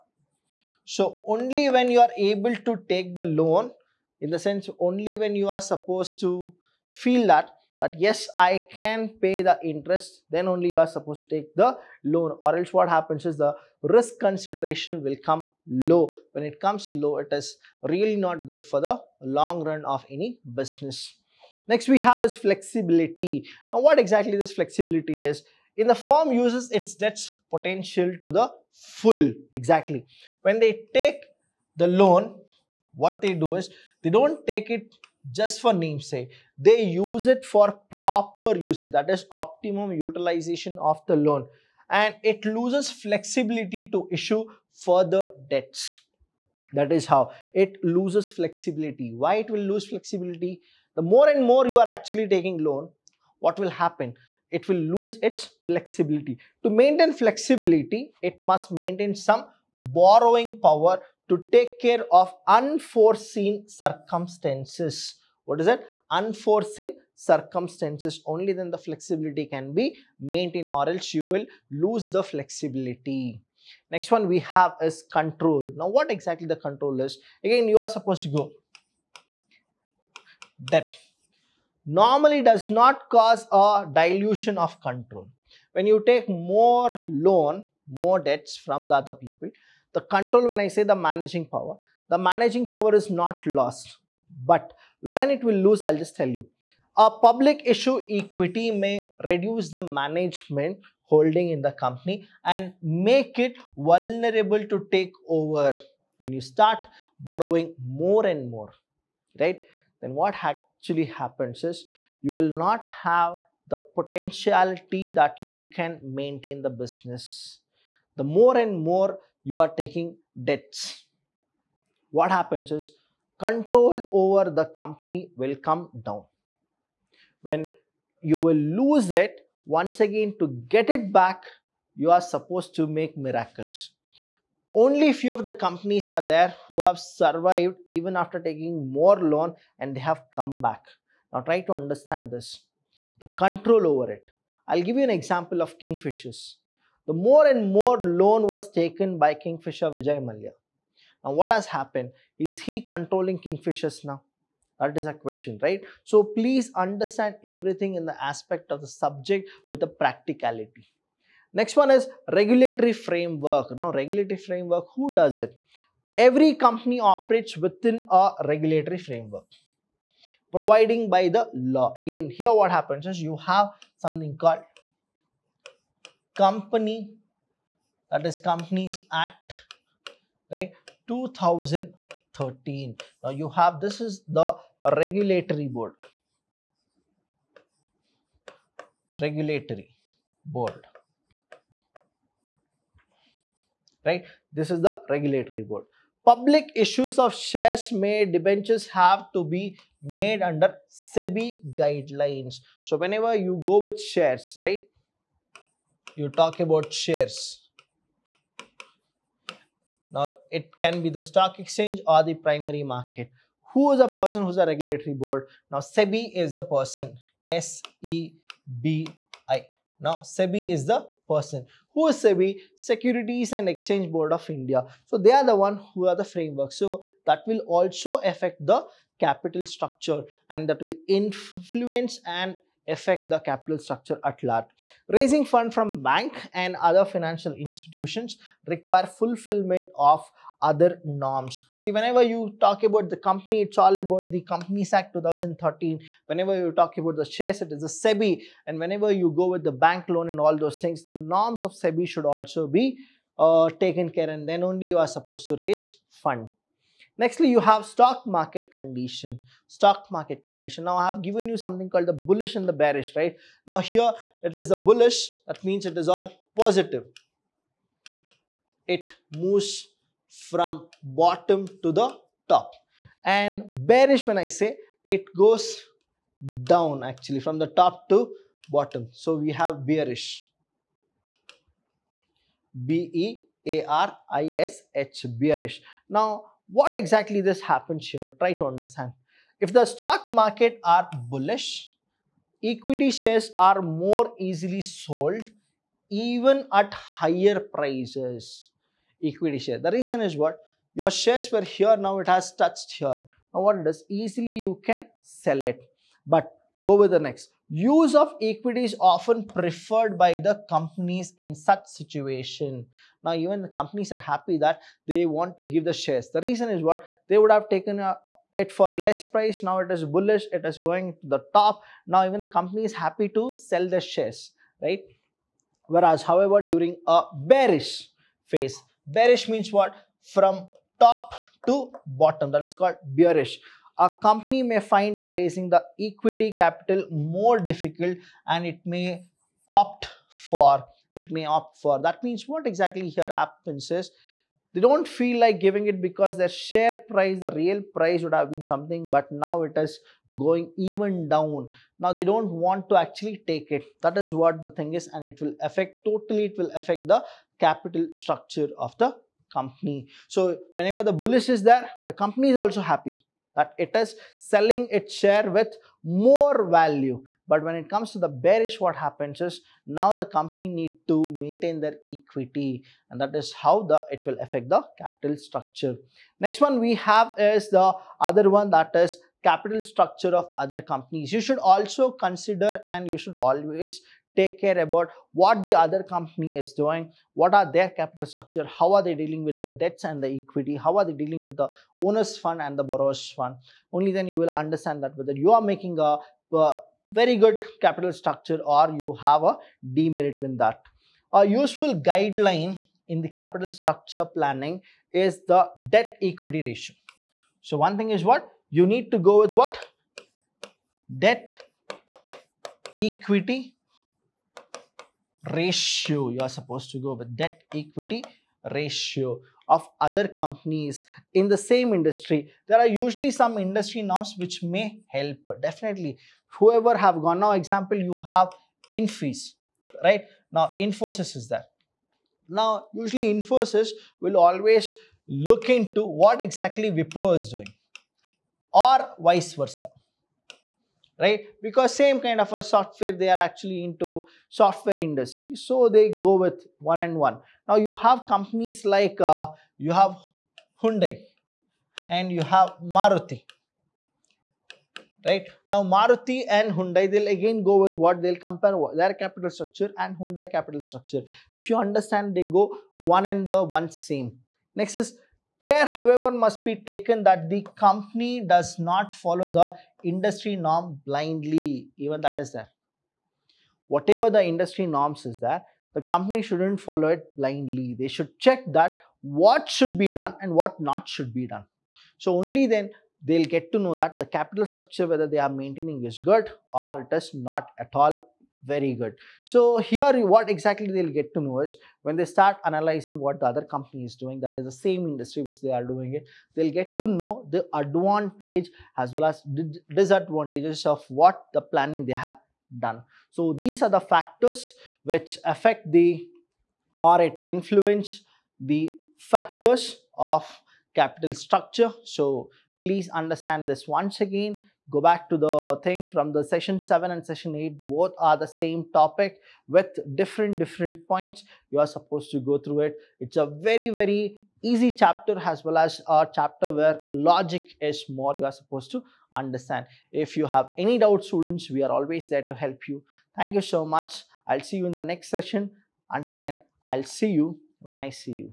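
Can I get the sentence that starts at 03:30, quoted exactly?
Now, it can be the stock exchange or the primary market.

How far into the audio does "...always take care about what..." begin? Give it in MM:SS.
06:23.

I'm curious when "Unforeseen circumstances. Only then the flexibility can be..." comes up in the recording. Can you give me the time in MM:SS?
01:06.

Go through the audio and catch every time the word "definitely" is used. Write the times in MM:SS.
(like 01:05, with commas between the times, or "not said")
07:05.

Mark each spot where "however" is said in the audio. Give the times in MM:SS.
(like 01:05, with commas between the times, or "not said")
05:26, 07:45.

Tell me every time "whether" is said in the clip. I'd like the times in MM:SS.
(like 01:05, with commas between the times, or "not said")
06:35, 08:05.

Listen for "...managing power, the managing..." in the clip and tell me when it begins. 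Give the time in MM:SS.
01:30.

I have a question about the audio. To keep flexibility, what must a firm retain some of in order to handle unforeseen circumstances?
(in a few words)
Borrowing power.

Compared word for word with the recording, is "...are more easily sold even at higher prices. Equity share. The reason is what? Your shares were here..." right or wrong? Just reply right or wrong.
right.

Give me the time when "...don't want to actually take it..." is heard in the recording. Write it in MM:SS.
05:52.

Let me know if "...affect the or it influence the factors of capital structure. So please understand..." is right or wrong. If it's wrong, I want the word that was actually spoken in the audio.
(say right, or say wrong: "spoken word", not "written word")
right.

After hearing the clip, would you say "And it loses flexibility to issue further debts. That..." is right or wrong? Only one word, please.
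right.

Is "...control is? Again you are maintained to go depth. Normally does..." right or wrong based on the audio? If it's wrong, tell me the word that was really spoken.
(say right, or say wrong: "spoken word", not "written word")
wrong: "supposed", not "maintained".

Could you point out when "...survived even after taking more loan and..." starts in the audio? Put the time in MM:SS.
02:16.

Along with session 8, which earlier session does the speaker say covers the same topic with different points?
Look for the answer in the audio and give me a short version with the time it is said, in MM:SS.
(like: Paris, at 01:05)
Session 7, at 08:36.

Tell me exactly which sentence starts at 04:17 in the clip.
Nextly, you have stock market condition.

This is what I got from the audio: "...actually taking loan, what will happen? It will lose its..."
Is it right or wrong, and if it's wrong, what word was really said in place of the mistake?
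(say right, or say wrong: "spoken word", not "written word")
right.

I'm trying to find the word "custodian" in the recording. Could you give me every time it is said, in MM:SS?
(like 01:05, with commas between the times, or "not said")
not said.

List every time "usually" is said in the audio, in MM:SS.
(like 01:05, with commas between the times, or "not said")
07:02, 07:12.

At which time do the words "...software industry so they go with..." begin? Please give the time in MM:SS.
07:24.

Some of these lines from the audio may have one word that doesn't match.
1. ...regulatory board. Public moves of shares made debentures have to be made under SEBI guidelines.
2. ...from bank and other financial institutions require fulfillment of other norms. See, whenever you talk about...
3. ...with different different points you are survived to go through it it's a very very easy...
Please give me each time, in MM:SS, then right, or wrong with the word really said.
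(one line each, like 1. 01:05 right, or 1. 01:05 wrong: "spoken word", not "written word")
1. 03:15 wrong: "issues", not "moves"
2. 03:55 right
3. 08:39 wrong: "supposed", not "survived".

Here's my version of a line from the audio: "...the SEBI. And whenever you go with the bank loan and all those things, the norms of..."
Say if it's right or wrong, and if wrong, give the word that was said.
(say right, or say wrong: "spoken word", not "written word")
right.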